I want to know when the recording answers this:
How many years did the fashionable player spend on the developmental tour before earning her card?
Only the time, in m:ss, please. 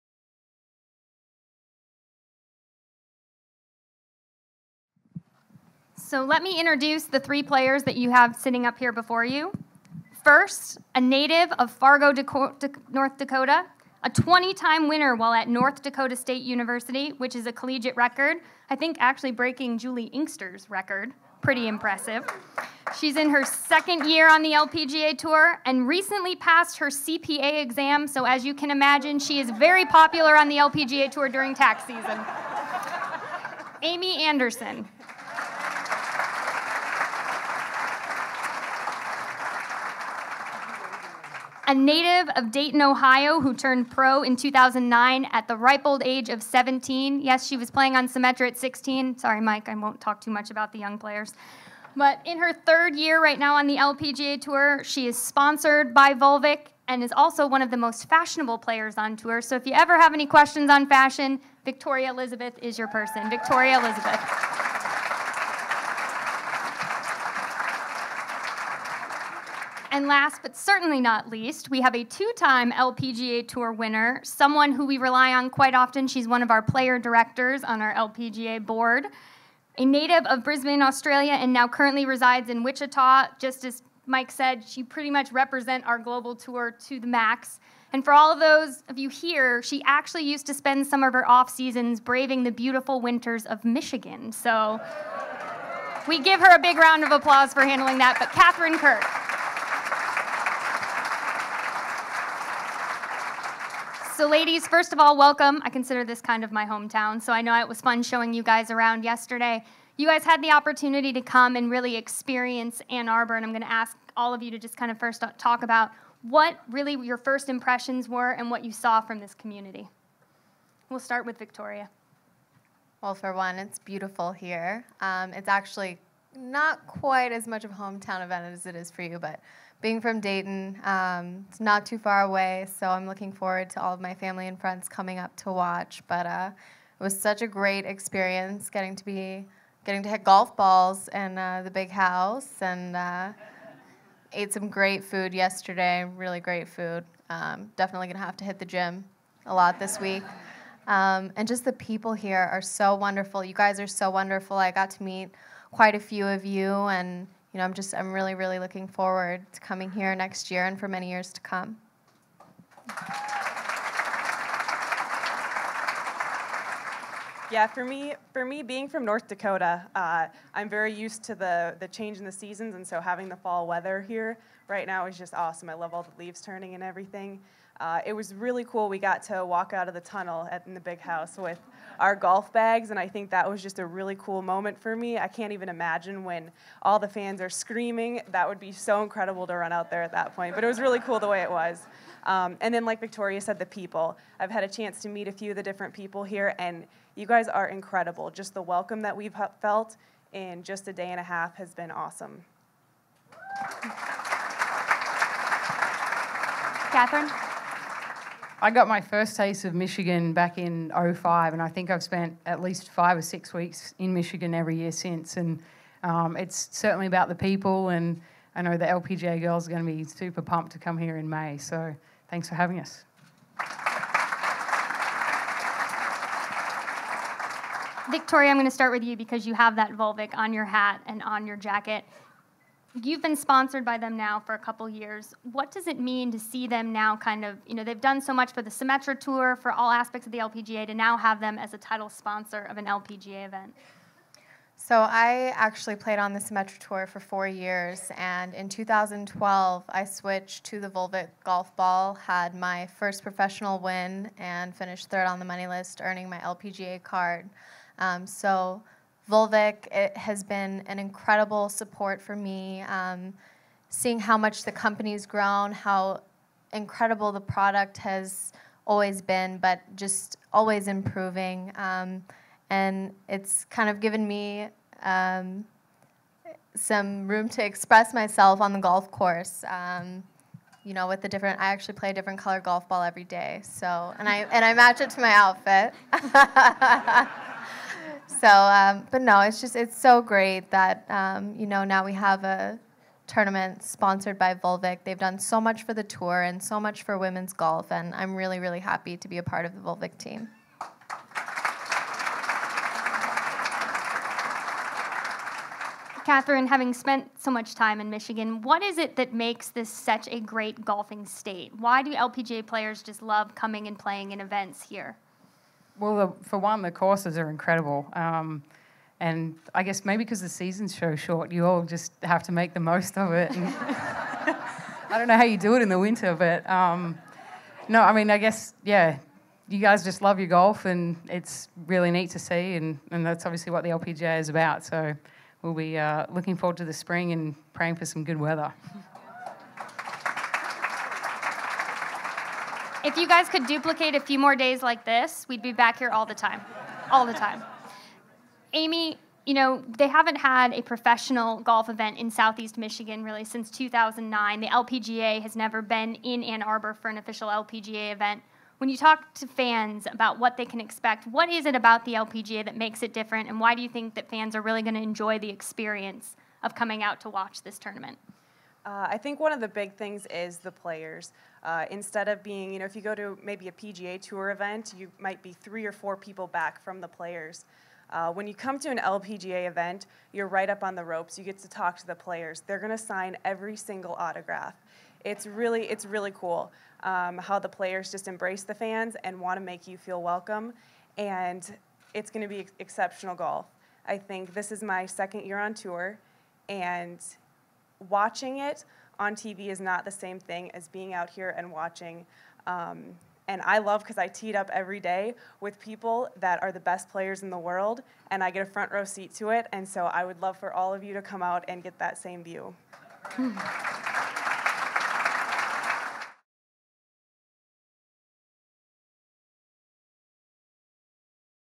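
4:07.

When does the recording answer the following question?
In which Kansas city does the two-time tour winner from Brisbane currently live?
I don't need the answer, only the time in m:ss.
1:22.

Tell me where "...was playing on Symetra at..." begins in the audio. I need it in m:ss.
0:47.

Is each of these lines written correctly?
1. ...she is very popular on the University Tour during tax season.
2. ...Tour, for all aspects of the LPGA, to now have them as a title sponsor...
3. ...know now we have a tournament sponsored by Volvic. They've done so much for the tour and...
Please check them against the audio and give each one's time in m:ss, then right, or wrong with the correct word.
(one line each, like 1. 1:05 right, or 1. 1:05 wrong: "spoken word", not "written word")
1. 0:29 wrong: "LPGA", not "University"
2. 3:59 right
3. 4:51 right.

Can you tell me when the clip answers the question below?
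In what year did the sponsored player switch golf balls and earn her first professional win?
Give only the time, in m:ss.
4:08.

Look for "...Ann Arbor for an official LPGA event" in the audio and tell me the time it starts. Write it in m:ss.
5:56.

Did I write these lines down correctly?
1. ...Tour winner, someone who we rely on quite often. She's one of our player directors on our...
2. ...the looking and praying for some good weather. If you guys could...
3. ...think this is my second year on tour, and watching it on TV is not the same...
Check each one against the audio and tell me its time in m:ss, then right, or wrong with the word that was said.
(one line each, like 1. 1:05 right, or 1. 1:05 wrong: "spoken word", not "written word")
1. 1:13 right
2. 5:36 wrong: "spring", not "looking"
3. 6:34 right.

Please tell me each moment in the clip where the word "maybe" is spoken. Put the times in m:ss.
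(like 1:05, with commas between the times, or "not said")
5:20, 6:13.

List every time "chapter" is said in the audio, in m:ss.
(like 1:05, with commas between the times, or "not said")
not said.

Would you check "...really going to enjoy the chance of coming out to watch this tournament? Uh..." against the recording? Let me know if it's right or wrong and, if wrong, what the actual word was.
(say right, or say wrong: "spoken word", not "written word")
wrong: "experience", not "chance".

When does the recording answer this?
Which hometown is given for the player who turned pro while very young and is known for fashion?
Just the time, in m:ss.
0:42.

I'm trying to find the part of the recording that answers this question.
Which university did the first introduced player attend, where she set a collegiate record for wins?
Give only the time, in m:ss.
0:15.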